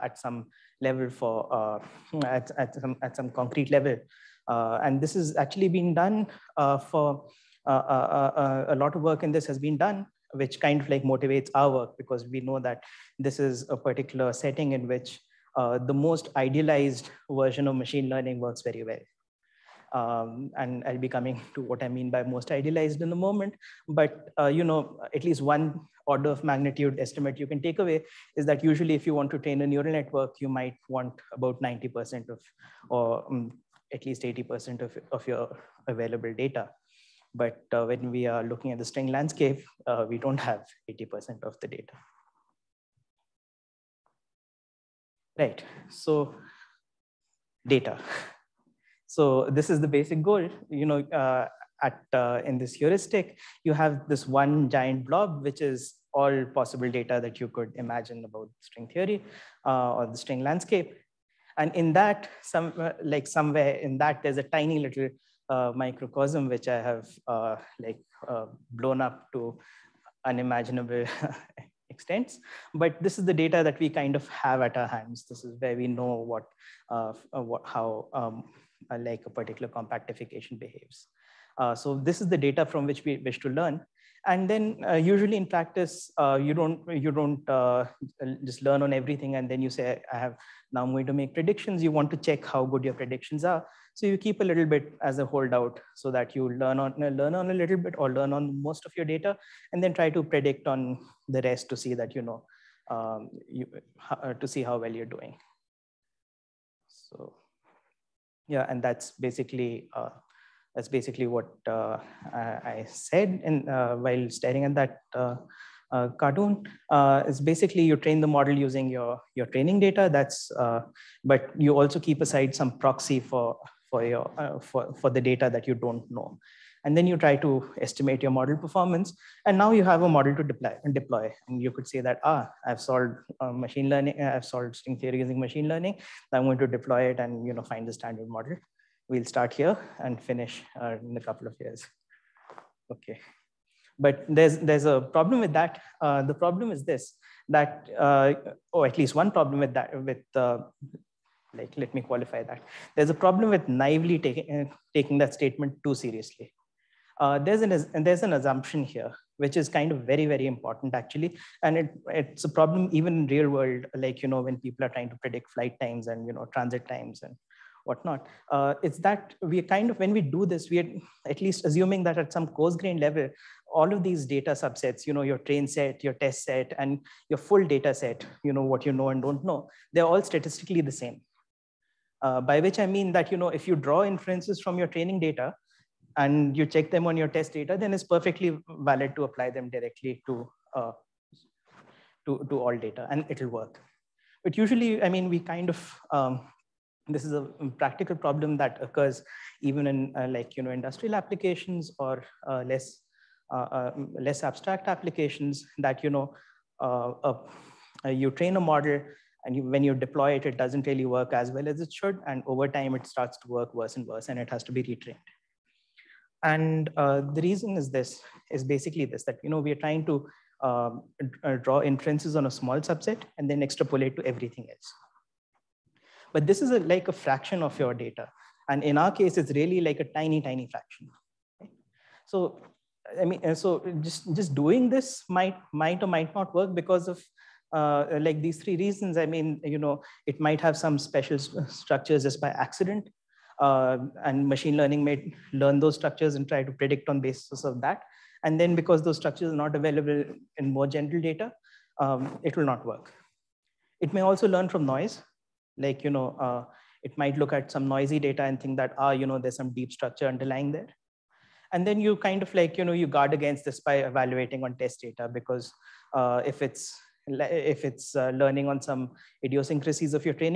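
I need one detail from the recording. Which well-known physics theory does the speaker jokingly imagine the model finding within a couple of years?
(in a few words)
the standard model.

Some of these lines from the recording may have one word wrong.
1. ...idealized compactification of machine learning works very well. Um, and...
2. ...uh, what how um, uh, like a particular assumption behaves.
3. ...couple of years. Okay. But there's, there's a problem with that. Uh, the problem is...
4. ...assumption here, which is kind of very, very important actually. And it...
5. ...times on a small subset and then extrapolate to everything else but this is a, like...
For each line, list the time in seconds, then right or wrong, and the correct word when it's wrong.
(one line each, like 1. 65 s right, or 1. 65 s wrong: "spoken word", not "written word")
1. 16 s wrong: "version", not "compactification"
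2. 77 s wrong: "compactification", not "assumption"
3. 141 s right
4. 158 s right
5. 221 s wrong: "inferences", not "times".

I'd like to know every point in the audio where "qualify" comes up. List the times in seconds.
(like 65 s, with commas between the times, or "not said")
152 s.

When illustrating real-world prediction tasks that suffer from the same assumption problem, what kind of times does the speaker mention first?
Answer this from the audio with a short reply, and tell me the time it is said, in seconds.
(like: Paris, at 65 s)
flight times, at 165 s.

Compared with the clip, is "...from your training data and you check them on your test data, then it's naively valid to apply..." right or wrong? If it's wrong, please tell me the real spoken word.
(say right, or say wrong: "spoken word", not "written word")
wrong: "perfectly", not "naively".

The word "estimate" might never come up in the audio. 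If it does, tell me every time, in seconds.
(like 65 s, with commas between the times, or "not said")
26 s, 127 s.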